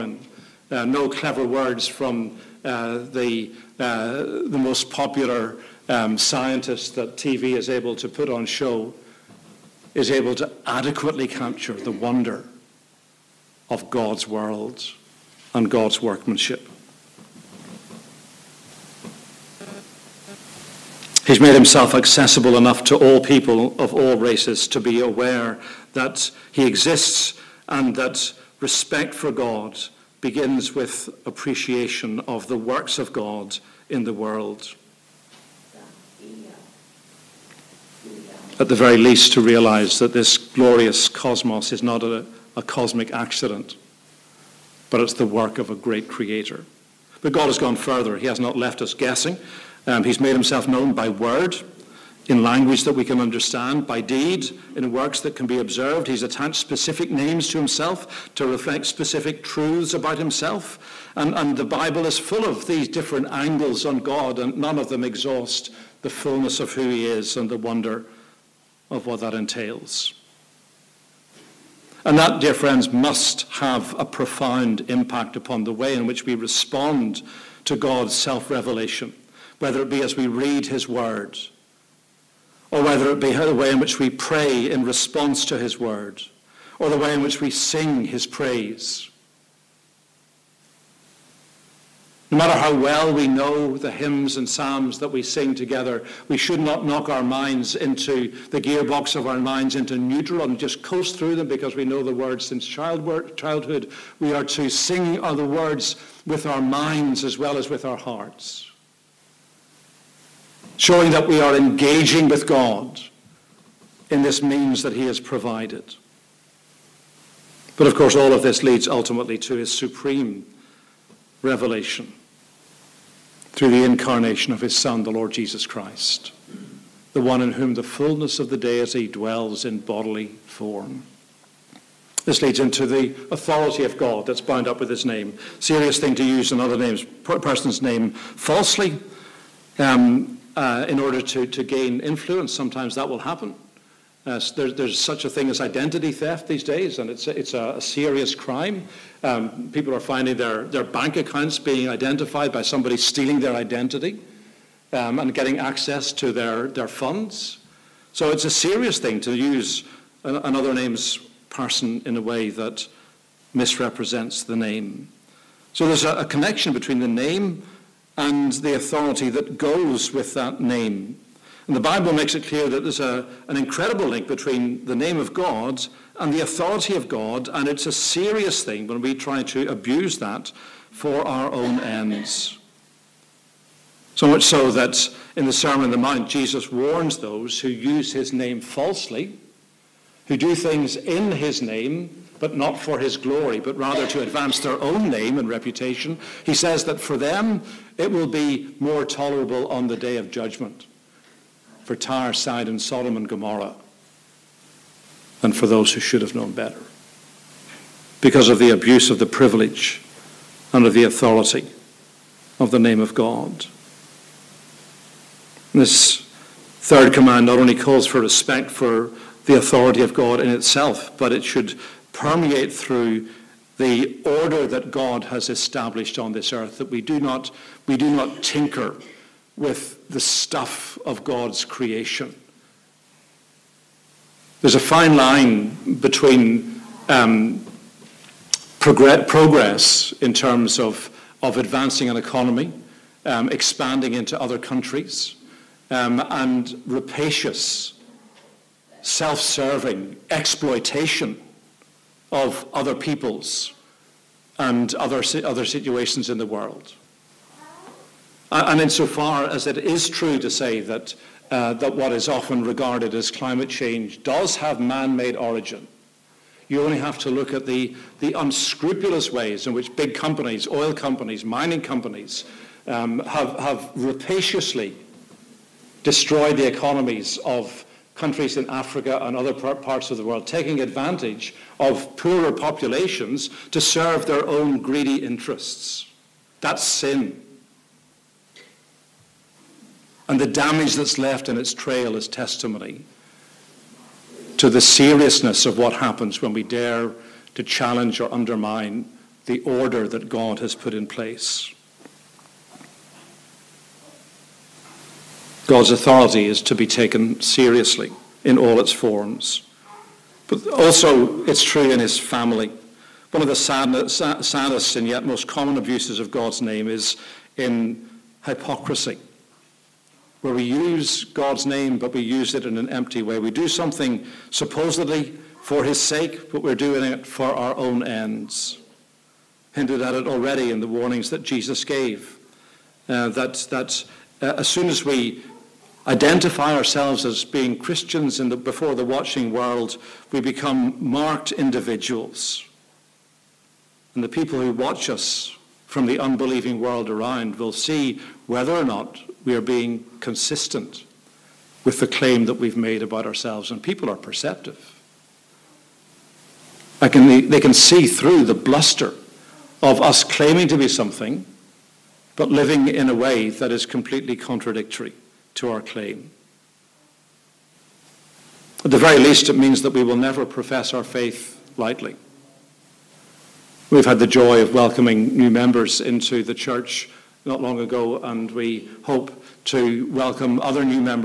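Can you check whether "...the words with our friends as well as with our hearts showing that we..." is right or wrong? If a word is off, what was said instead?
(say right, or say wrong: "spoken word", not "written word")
wrong: "minds", not "friends".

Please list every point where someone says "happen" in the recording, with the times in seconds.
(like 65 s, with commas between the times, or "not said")
143 s, 295 s.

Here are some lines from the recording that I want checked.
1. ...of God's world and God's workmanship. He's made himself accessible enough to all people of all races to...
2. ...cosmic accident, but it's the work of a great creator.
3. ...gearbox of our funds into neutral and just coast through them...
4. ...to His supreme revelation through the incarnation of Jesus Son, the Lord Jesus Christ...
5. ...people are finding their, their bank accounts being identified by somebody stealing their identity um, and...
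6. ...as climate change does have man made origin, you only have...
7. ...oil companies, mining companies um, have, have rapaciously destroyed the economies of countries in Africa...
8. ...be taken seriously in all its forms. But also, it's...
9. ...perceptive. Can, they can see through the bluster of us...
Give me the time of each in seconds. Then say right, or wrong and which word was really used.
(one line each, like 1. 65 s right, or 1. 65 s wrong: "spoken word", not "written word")
1. 13 s right
2. 42 s right
3. 98 s wrong: "minds", not "funds"
4. 119 s wrong: "His", not "Jesus"
5. 149 s right
6. 263 s right
7. 270 s right
8. 306 s right
9. 354 s right.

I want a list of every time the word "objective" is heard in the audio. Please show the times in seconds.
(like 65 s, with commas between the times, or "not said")
not said.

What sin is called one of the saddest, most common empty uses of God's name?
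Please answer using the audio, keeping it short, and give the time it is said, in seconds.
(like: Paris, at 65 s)
hypocrisy, at 318 s.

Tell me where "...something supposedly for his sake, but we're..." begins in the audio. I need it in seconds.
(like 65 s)
323 s.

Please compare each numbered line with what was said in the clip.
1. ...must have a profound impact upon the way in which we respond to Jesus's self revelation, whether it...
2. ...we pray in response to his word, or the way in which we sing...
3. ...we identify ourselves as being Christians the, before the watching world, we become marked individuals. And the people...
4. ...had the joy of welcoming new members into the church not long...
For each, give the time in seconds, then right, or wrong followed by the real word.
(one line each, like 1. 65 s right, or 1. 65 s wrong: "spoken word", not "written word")
1. 72 s wrong: "God", not "Jesus"
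2. 83 s right
3. 335 s right
4. 374 s right.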